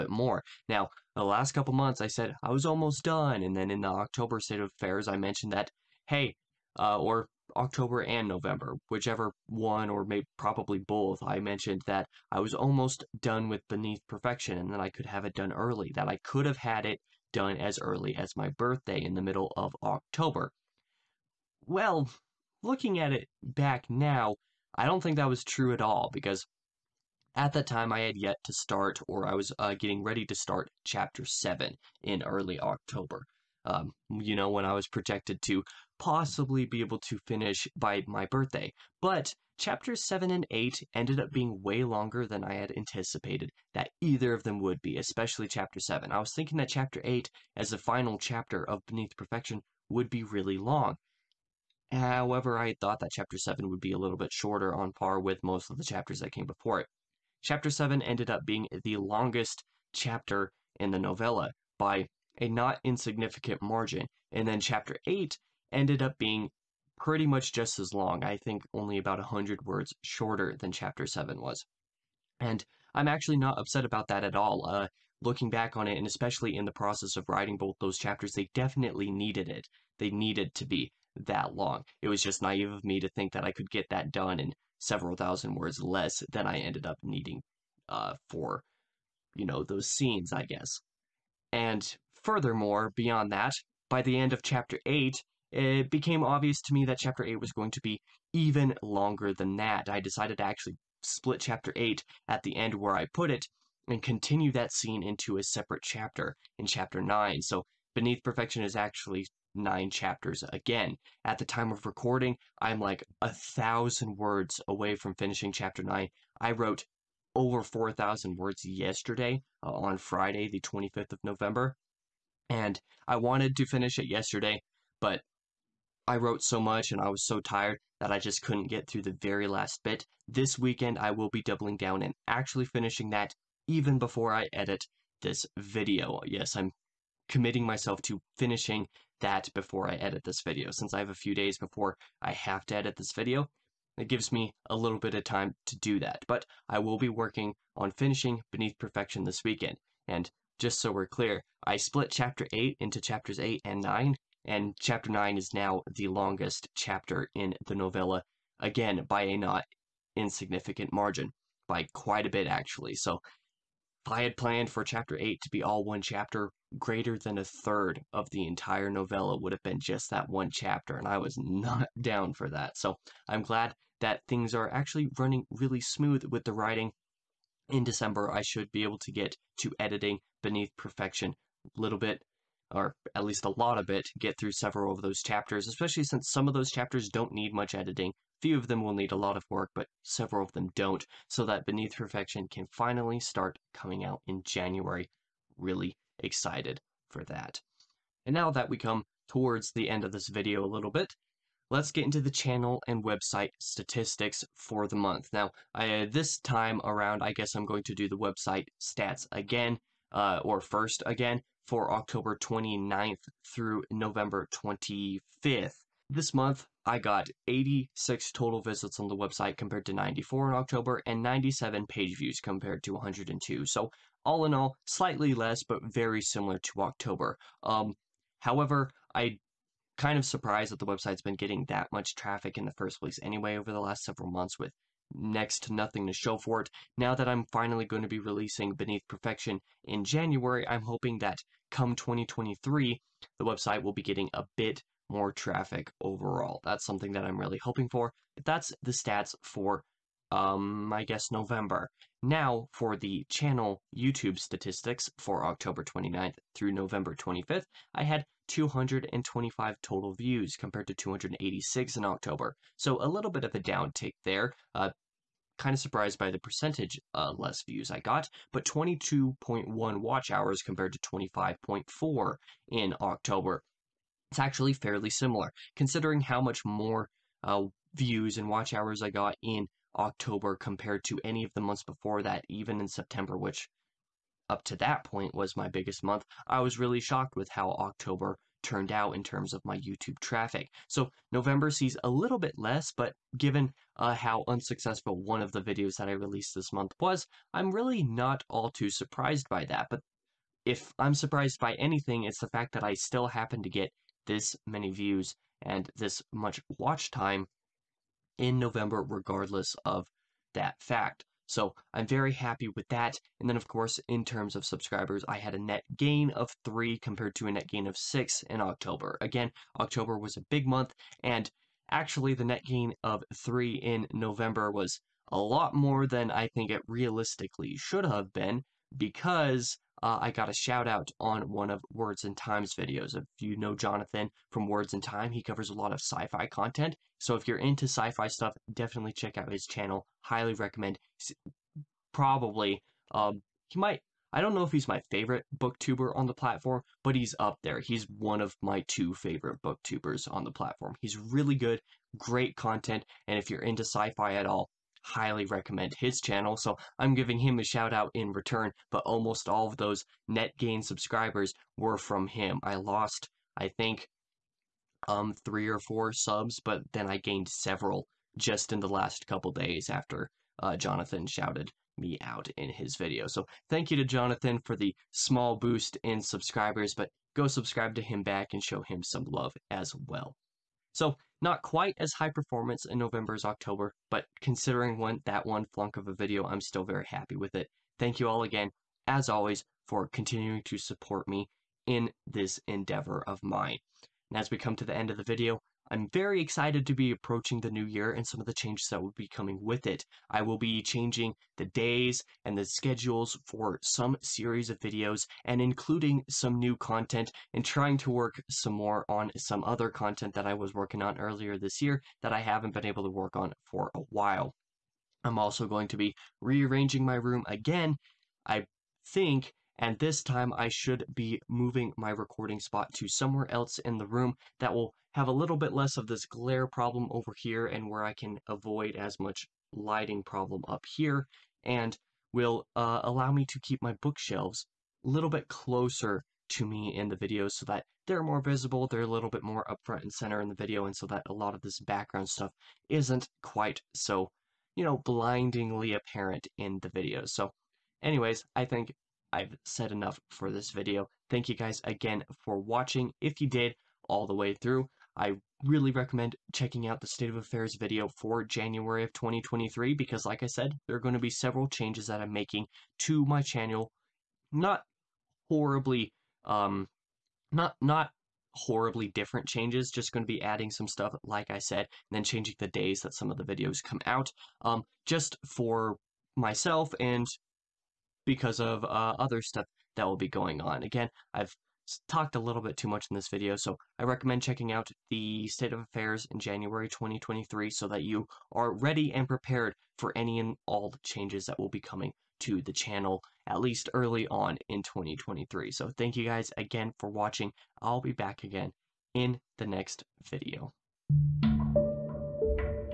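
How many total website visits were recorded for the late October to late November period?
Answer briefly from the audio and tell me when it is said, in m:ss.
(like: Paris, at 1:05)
86, at 3:37.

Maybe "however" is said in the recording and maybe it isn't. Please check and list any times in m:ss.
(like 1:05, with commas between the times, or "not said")
0:51, 3:48.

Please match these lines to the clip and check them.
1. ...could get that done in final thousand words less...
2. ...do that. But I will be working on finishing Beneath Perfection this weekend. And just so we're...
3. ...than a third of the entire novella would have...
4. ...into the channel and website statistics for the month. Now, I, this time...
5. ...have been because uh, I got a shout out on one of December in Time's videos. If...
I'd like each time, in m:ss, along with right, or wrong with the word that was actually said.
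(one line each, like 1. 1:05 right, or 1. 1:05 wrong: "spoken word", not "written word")
1. 1:23 wrong: "several", not "final"
2. 2:25 right
3. 2:47 right
4. 3:22 right
5. 5:28 wrong: "Words", not "December".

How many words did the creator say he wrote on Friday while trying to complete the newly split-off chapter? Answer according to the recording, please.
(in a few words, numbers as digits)
Over 4,000.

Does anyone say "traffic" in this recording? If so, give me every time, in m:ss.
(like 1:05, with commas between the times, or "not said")
3:52, 4:05, 4:50.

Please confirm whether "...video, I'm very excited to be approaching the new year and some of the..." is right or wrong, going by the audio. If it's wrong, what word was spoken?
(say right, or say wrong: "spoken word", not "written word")
right.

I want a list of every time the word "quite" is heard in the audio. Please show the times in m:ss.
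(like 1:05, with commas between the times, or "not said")
2:41, 6:21, 7:23.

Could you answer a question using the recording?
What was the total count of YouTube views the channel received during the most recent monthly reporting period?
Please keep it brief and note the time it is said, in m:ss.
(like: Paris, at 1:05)
225, at 4:18.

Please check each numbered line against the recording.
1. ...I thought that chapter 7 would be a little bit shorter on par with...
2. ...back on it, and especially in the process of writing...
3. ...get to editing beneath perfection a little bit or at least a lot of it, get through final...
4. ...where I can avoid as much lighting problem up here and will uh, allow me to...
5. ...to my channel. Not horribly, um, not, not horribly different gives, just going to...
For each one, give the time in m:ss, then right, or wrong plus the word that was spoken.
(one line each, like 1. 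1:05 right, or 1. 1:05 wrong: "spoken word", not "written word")
1. 0:52 right
2. 1:15 right
3. 2:59 wrong: "several", not "final"
4. 7:07 right
5. 7:43 wrong: "changes", not "gives".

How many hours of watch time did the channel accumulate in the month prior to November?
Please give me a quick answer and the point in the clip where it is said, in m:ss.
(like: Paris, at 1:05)
25.4, at 4:30.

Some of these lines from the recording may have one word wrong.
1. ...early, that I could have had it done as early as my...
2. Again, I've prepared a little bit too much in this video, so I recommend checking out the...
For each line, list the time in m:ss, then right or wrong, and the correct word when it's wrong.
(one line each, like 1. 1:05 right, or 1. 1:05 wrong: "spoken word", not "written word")
1. 0:15 right
2. 8:00 wrong: "talked", not "prepared".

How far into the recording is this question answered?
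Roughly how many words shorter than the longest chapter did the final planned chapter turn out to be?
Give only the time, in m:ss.
1:09.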